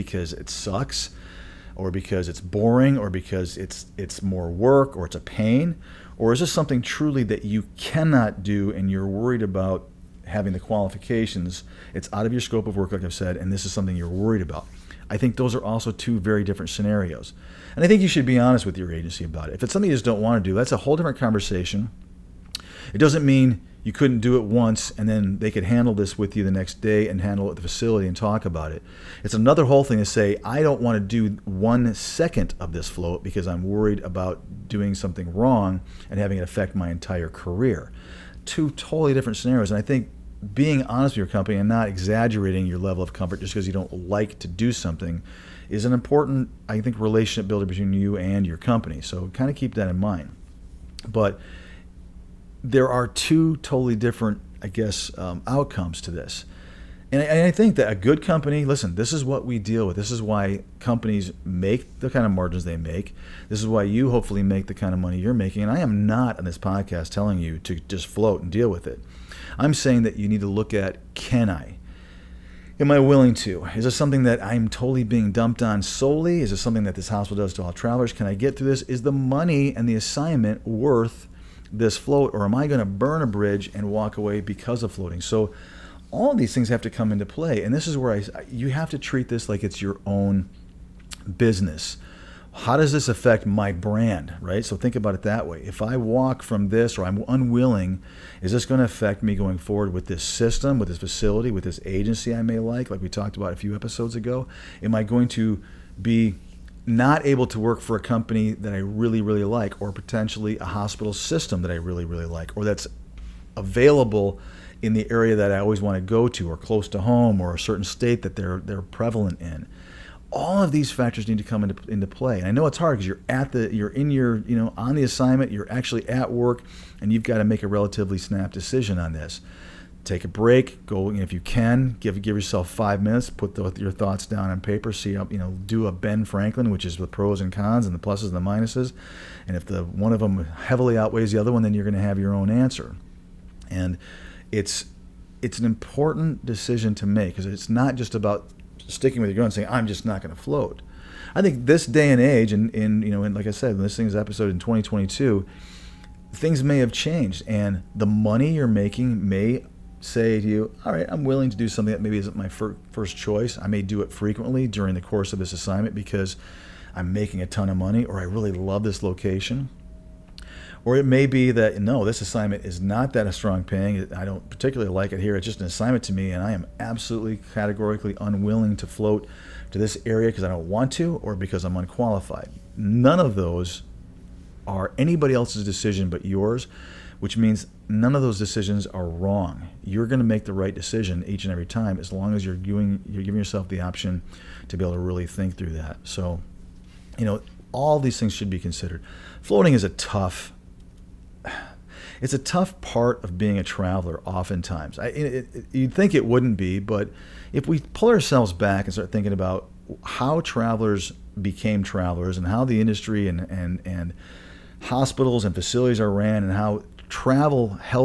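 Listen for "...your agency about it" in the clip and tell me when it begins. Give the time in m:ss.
0:18.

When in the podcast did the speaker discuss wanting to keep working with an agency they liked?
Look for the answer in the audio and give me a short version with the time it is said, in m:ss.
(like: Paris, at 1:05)
A few episodes ago, at 1:43.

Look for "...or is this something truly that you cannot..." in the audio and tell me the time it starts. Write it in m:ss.
0:06.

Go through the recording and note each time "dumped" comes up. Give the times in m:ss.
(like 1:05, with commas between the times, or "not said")
1:15.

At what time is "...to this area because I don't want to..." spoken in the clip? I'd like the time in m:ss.
2:59.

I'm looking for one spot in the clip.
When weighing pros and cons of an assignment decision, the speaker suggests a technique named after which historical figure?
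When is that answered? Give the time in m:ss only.
2:15.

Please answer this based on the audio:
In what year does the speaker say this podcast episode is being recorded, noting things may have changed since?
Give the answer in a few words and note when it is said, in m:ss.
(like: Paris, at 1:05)
2022, at 2:34.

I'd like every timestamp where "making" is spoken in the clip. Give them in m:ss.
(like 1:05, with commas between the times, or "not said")
1:05, 2:38, 2:47.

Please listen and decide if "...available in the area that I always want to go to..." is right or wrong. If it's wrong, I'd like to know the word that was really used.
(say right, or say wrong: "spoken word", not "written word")
right.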